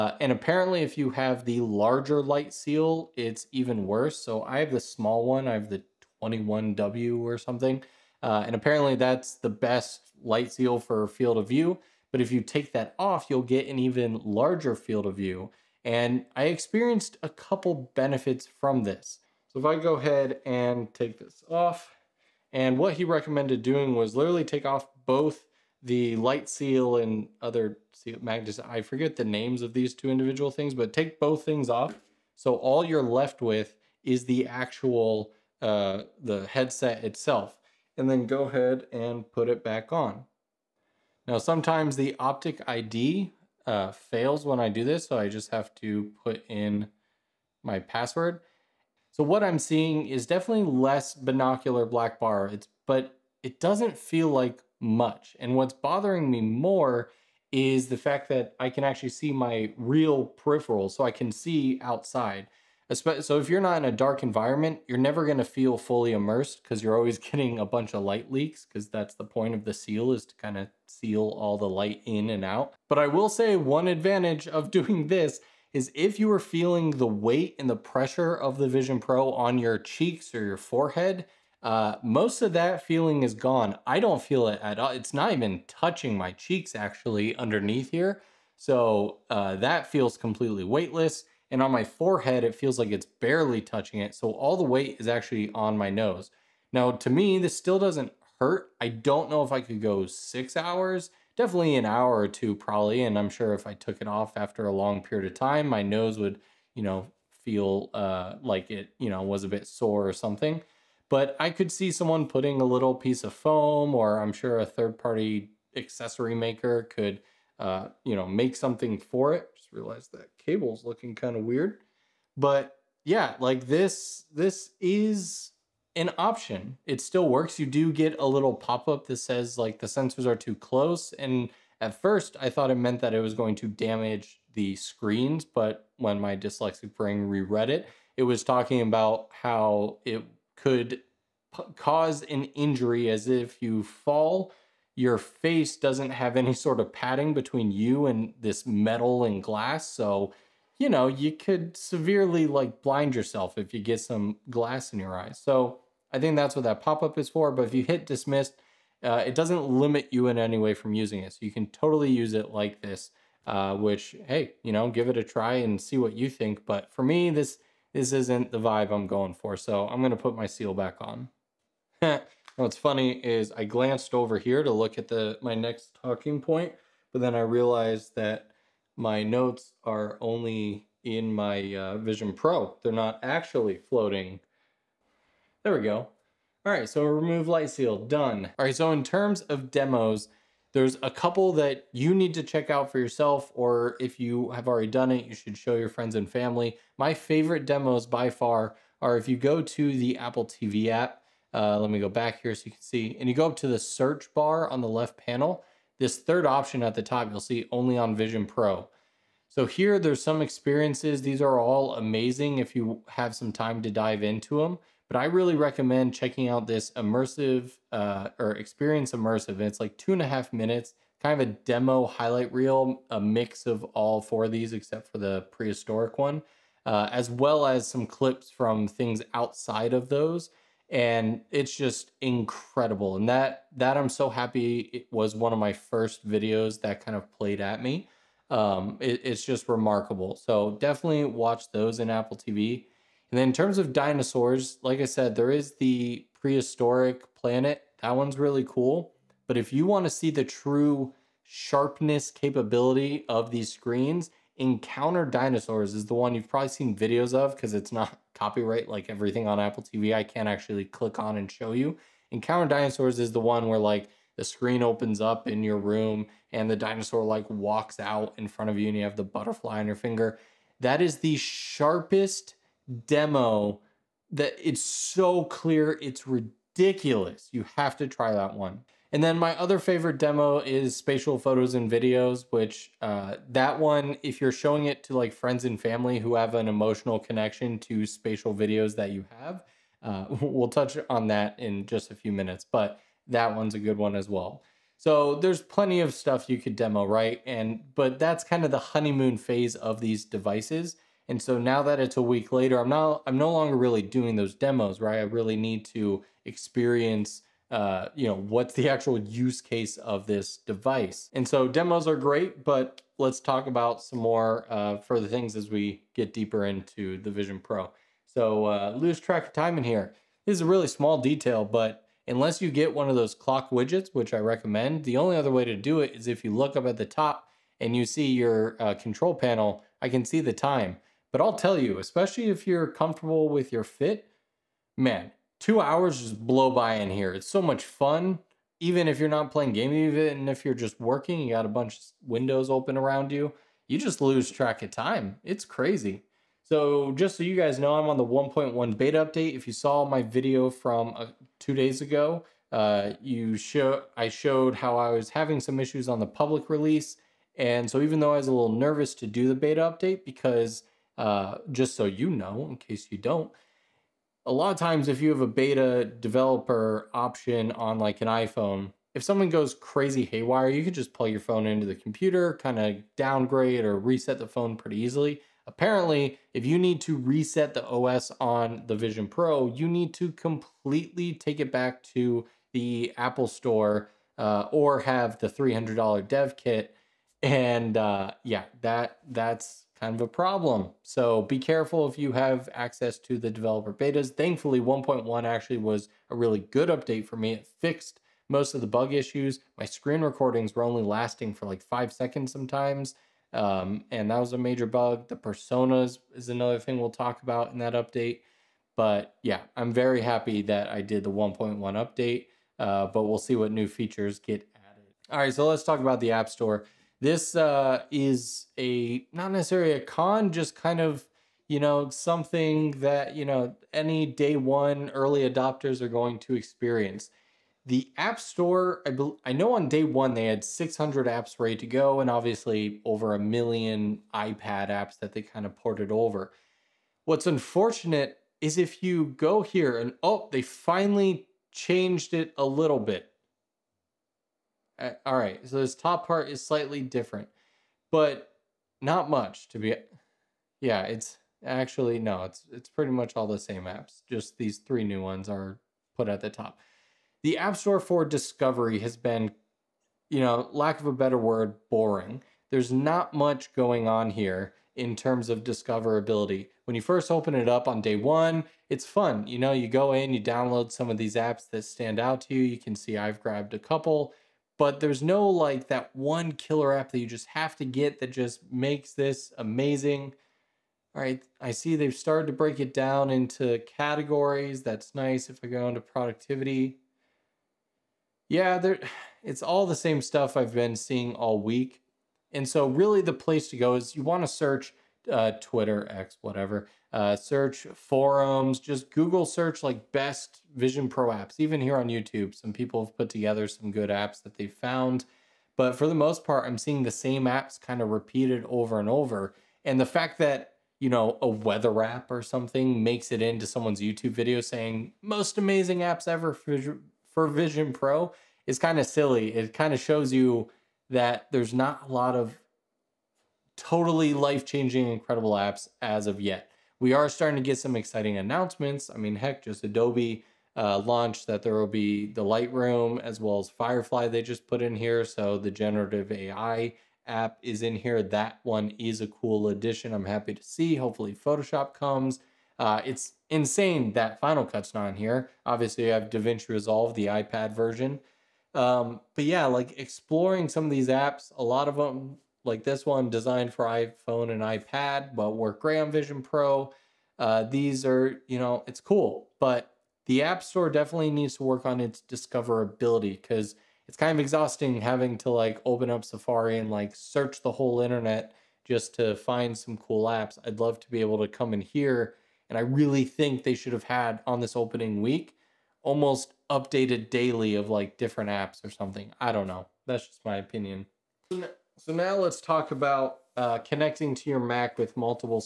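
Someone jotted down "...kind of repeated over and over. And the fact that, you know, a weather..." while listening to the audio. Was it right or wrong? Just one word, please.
right.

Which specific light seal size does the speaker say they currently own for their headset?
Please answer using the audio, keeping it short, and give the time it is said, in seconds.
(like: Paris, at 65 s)
21W, at 6 s.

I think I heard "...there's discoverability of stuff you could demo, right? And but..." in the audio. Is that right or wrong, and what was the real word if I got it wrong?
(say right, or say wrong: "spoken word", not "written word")
wrong: "plenty", not "discoverability".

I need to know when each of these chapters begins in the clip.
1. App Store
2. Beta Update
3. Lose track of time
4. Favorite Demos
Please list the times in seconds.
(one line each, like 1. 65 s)
1. 414 s
2. 344 s
3. 317 s
4. 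187 s.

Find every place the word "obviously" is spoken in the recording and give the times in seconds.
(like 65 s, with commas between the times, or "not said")
432 s, 545 s.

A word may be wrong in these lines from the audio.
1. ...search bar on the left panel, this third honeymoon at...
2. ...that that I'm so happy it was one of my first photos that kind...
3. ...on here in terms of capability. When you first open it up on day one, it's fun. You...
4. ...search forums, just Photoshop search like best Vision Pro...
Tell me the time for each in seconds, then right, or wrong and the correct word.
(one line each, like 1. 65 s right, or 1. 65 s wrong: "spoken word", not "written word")
1. 203 s wrong: "option", not "honeymoon"
2. 233 s wrong: "videos", not "photos"
3. 464 s wrong: "discoverability", not "capability"
4. 497 s wrong: "Google", not "Photoshop".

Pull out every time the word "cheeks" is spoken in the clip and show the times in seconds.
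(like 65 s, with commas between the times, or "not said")
79 s, 86 s.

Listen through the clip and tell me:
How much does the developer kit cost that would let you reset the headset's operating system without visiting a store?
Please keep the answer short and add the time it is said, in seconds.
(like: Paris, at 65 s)
$300, at 385 s.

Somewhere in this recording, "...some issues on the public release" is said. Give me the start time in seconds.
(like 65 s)
355 s.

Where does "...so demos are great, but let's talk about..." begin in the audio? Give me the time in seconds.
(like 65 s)
311 s.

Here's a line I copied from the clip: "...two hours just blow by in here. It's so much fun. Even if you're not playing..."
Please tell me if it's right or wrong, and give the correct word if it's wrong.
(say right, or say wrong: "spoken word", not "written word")
right.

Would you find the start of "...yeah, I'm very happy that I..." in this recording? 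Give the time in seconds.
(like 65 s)
409 s.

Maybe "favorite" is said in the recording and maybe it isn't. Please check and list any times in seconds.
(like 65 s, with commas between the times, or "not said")
197 s, 279 s.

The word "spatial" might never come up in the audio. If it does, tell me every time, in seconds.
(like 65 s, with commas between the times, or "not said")
280 s, 288 s.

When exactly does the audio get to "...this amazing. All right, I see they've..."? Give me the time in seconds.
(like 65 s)
479 s.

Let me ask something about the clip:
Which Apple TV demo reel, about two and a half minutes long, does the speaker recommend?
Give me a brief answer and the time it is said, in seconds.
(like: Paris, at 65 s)
Experience Immersive, at 218 s.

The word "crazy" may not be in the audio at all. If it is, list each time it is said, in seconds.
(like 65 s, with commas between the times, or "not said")
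345 s, 369 s.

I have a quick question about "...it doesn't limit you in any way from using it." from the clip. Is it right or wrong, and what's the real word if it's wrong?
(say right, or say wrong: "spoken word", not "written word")
right.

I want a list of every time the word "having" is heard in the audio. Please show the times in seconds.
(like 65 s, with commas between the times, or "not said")
355 s, 564 s.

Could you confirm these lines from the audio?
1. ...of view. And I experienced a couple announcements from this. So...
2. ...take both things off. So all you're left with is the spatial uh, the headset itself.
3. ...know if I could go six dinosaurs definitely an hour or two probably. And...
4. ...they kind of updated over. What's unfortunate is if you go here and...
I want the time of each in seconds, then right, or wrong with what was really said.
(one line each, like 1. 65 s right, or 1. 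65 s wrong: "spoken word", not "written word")
1. 15 s wrong: "benefits", not "announcements"
2. 30 s wrong: "actual", not "spatial"
3. 99 s wrong: "hours", not "dinosaurs"
4. 435 s wrong: "ported", not "updated".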